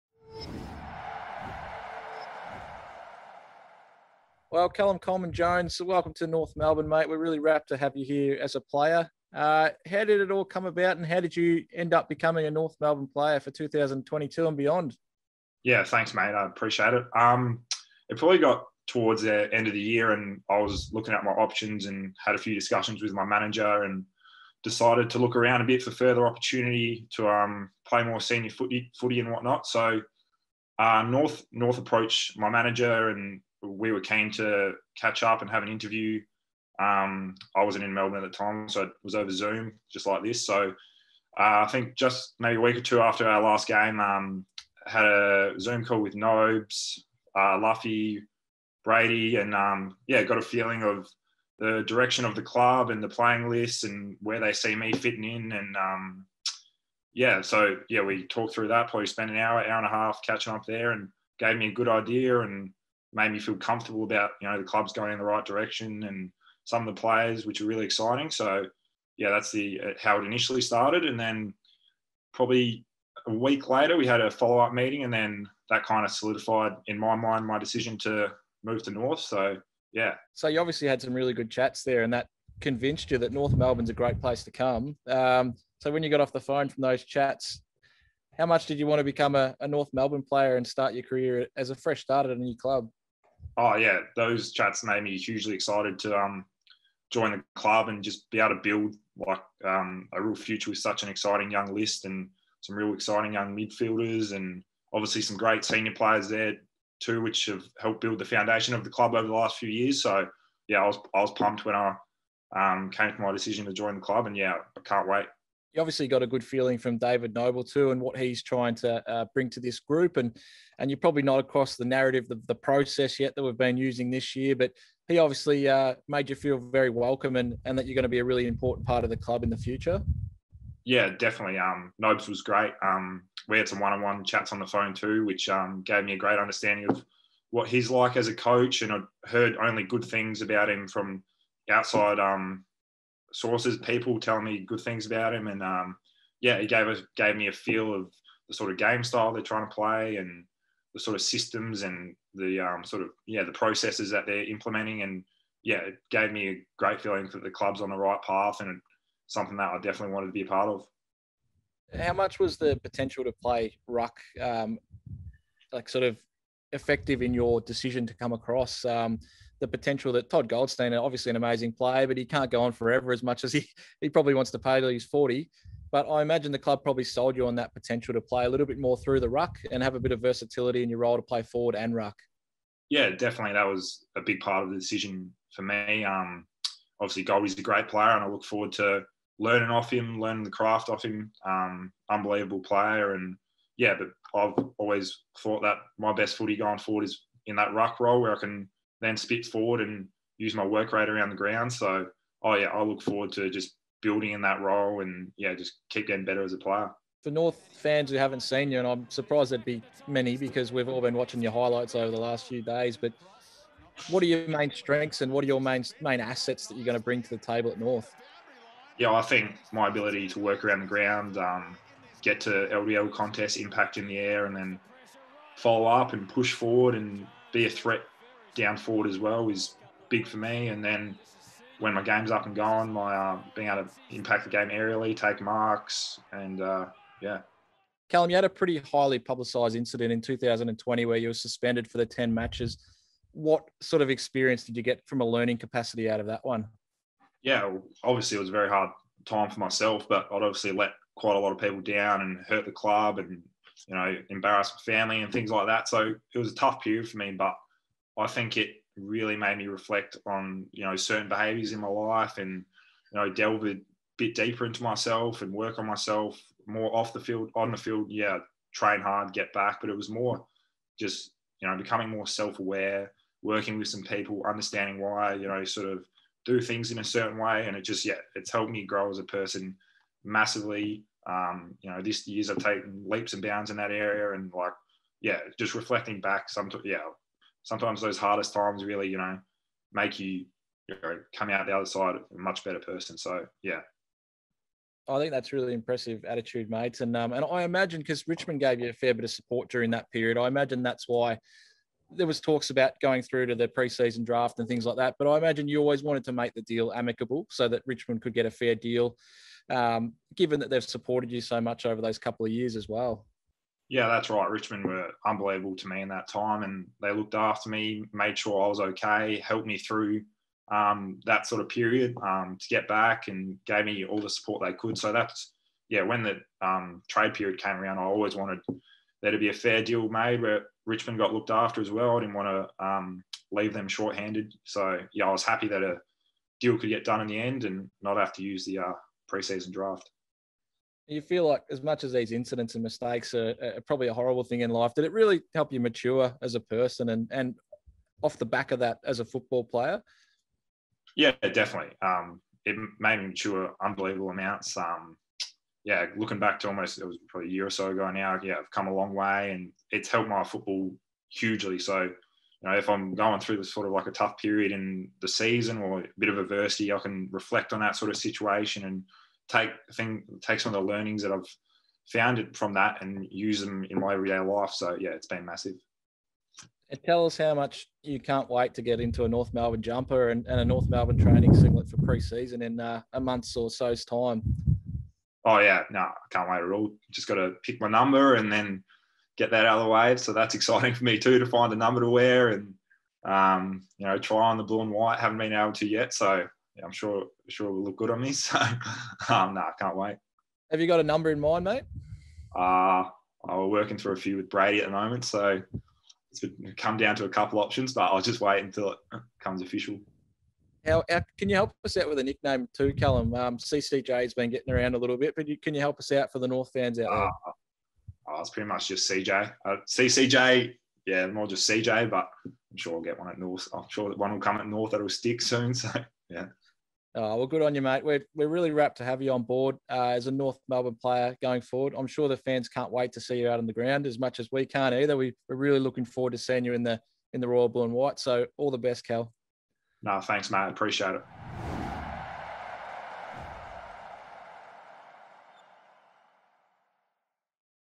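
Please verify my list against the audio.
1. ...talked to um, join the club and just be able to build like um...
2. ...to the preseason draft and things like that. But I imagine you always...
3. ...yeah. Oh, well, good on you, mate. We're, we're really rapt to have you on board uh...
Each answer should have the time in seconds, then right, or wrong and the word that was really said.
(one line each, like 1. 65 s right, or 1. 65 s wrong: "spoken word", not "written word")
1. 95 s wrong: "excited", not "talked"
2. 303 s right
3. 426 s right.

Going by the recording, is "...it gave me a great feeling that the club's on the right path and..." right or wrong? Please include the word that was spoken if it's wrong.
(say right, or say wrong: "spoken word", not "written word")
right.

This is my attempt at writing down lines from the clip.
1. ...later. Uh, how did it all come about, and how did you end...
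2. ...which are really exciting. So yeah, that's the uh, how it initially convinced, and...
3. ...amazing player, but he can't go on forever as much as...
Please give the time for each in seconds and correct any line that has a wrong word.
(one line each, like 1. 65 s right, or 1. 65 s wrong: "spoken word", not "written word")
1. 8 s wrong: "player", not "later"
2. 67 s wrong: "started", not "convinced"
3. 171 s right.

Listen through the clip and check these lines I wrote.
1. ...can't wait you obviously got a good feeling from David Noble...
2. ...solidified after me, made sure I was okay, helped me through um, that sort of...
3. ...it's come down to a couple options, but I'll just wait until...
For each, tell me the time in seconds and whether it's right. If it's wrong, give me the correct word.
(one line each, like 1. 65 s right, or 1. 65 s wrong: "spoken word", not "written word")
1. 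114 s right
2. 317 s wrong: "looked", not "solidified"
3. 406 s right.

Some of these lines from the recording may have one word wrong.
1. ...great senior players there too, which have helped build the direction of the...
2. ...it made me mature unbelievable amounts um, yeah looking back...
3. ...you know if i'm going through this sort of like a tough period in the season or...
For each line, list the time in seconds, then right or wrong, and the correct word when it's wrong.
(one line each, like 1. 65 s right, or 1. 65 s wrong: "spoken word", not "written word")
1. 105 s wrong: "foundation", not "direction"
2. 352 s right
3. 362 s right.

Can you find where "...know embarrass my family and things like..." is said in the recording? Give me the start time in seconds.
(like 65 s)
253 s.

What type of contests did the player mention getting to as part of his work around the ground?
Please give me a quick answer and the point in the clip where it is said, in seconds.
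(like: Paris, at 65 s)
LDL contests, at 222 s.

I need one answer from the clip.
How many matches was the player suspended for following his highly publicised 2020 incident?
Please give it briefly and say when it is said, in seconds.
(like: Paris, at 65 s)
10, at 242 s.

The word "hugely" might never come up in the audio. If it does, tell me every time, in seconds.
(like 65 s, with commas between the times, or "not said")
95 s, 361 s.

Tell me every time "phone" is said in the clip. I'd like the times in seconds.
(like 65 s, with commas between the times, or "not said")
86 s, 134 s.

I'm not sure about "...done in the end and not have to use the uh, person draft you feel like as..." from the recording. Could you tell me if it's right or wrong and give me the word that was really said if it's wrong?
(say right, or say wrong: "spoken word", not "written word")
wrong: "preseason", not "person".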